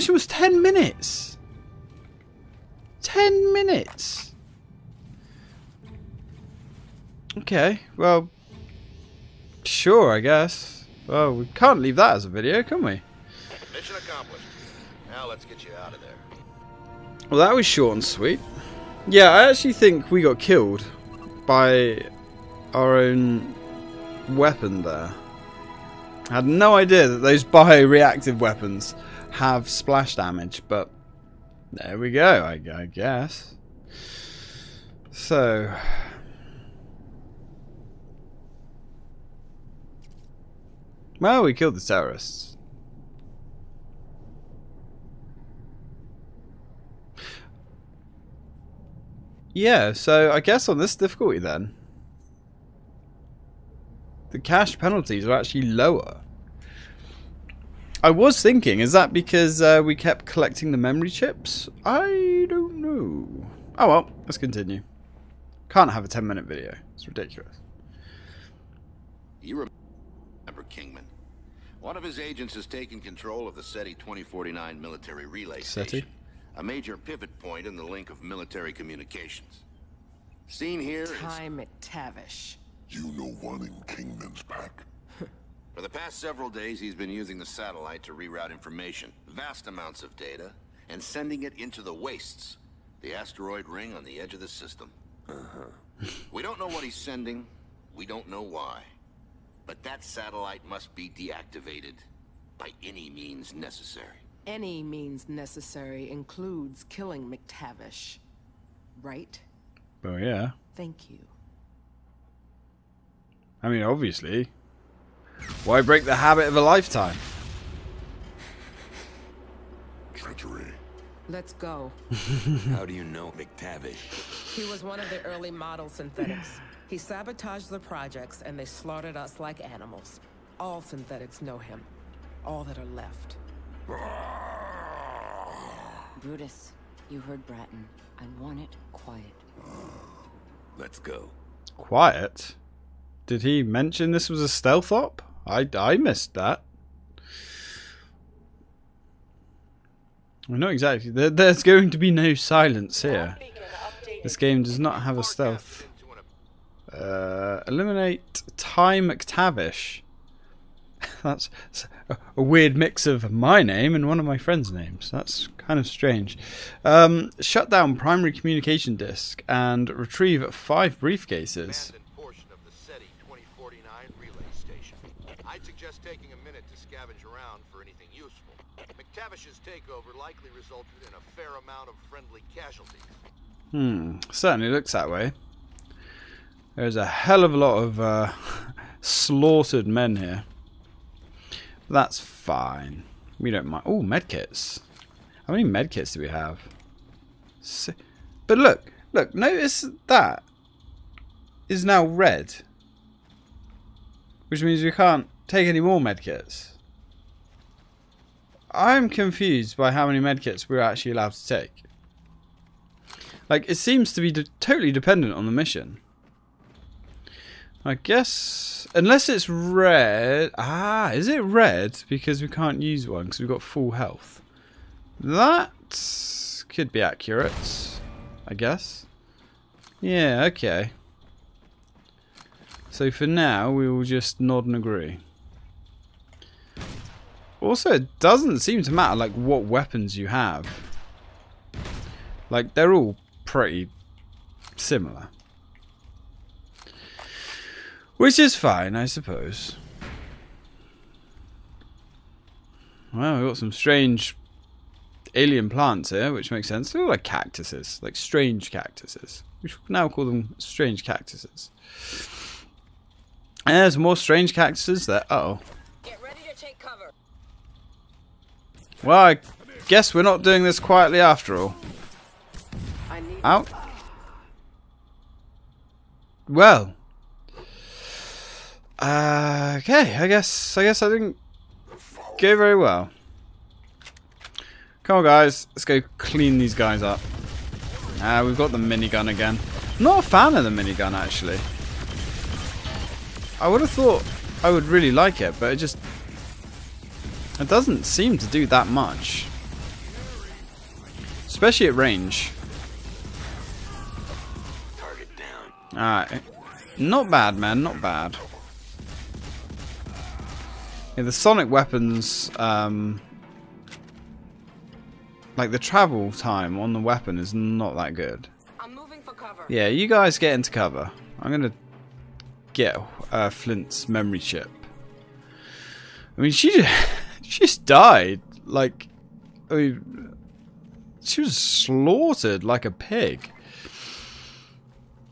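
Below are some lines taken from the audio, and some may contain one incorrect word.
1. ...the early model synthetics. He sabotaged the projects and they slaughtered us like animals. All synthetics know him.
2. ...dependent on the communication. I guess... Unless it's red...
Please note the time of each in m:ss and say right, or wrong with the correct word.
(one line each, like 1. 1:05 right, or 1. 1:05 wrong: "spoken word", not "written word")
1. 2:05 right
2. 3:34 wrong: "mission", not "communication".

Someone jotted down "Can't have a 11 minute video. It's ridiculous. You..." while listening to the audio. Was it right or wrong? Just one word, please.
wrong.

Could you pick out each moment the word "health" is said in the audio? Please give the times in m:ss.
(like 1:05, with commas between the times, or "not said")
3:43.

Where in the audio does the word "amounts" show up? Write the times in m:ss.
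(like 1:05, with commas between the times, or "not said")
1:29, 3:01.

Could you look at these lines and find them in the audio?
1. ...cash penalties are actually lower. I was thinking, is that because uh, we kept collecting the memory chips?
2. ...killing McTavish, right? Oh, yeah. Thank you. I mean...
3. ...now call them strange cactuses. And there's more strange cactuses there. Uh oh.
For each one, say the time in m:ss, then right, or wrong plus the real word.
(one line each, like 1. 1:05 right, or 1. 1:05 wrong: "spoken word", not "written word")
1. 0:54 right
2. 1:46 right
3. 4:19 right.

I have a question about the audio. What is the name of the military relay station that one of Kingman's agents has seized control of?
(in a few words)
SETI 2049.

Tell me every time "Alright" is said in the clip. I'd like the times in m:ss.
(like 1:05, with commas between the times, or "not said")
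5:05.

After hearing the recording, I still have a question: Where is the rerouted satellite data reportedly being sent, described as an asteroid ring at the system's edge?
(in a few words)
the wastes.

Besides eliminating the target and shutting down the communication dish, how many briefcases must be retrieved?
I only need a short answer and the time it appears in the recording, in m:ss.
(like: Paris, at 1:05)
5, at 2:50.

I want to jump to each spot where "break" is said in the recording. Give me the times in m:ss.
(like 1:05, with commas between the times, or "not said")
1:55.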